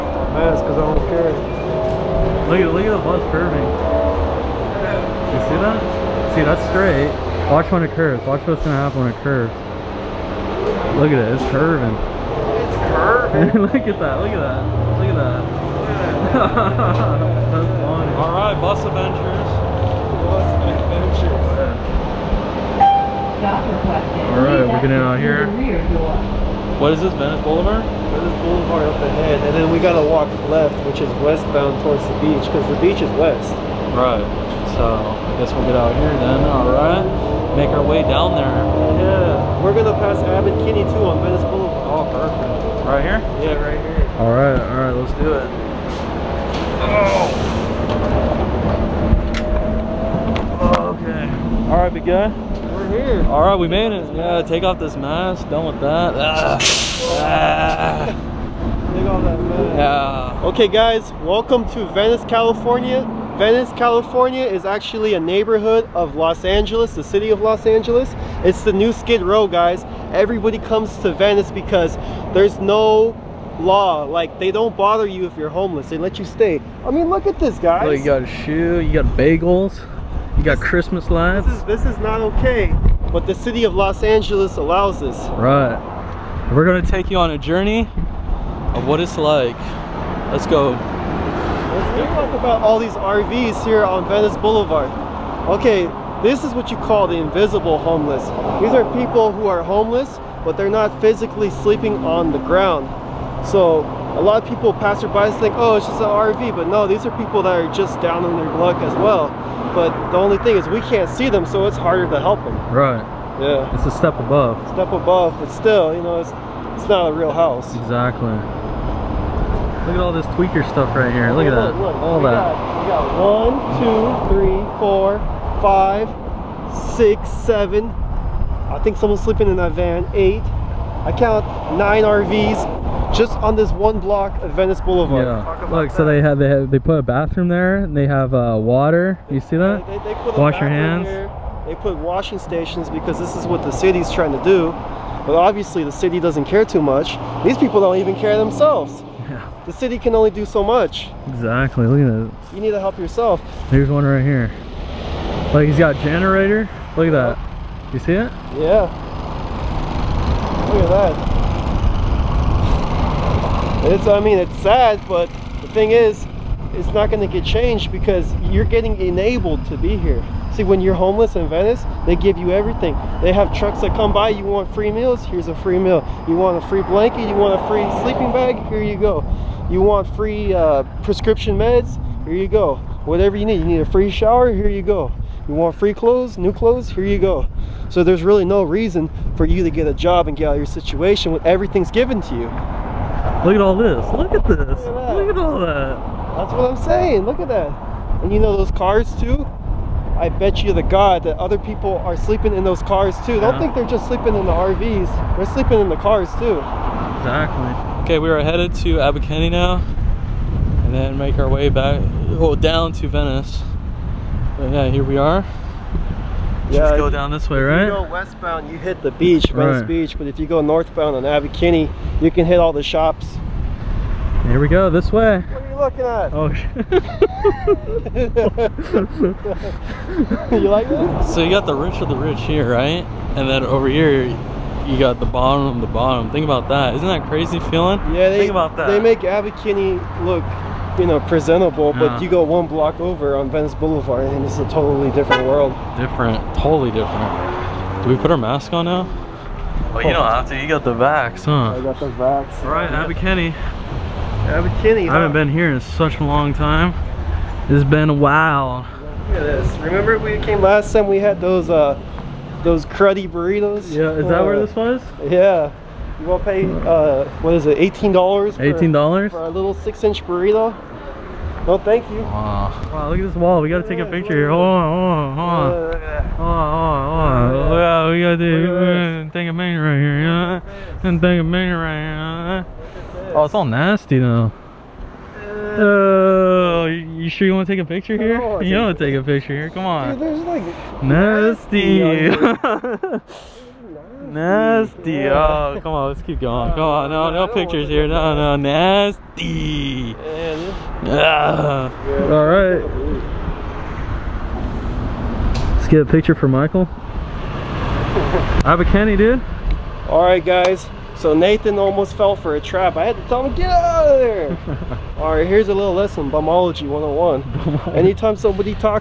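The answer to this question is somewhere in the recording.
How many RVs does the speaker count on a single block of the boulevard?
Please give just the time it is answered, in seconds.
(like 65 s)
131 s.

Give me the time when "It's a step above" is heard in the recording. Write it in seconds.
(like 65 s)
113 s.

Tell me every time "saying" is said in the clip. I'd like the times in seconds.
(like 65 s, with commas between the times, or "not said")
196 s.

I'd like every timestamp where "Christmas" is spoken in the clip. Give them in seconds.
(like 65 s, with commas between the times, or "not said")
80 s.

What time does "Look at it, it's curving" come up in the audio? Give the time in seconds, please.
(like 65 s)
10 s.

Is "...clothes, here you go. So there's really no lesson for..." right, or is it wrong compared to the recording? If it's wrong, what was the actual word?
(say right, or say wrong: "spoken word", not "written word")
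wrong: "reason", not "lesson".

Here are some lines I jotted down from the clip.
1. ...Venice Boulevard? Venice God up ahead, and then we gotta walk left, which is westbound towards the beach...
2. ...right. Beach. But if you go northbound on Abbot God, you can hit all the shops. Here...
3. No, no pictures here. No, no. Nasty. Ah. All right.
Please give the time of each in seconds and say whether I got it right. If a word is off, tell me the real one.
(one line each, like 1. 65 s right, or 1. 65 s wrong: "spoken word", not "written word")
1. 27 s wrong: "Boulevard", not "God"
2. 219 s wrong: "Kinney", not "God"
3. 297 s right.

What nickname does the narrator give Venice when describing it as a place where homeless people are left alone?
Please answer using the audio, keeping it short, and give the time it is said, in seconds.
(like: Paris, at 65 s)
The new Skid Row, at 68 s.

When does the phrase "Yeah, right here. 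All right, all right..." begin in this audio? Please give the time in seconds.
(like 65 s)
43 s.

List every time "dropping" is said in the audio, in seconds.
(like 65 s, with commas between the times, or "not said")
not said.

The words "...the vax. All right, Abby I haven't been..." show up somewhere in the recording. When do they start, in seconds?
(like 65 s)
251 s.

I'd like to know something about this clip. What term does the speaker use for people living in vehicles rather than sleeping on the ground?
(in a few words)
Invisible homeless.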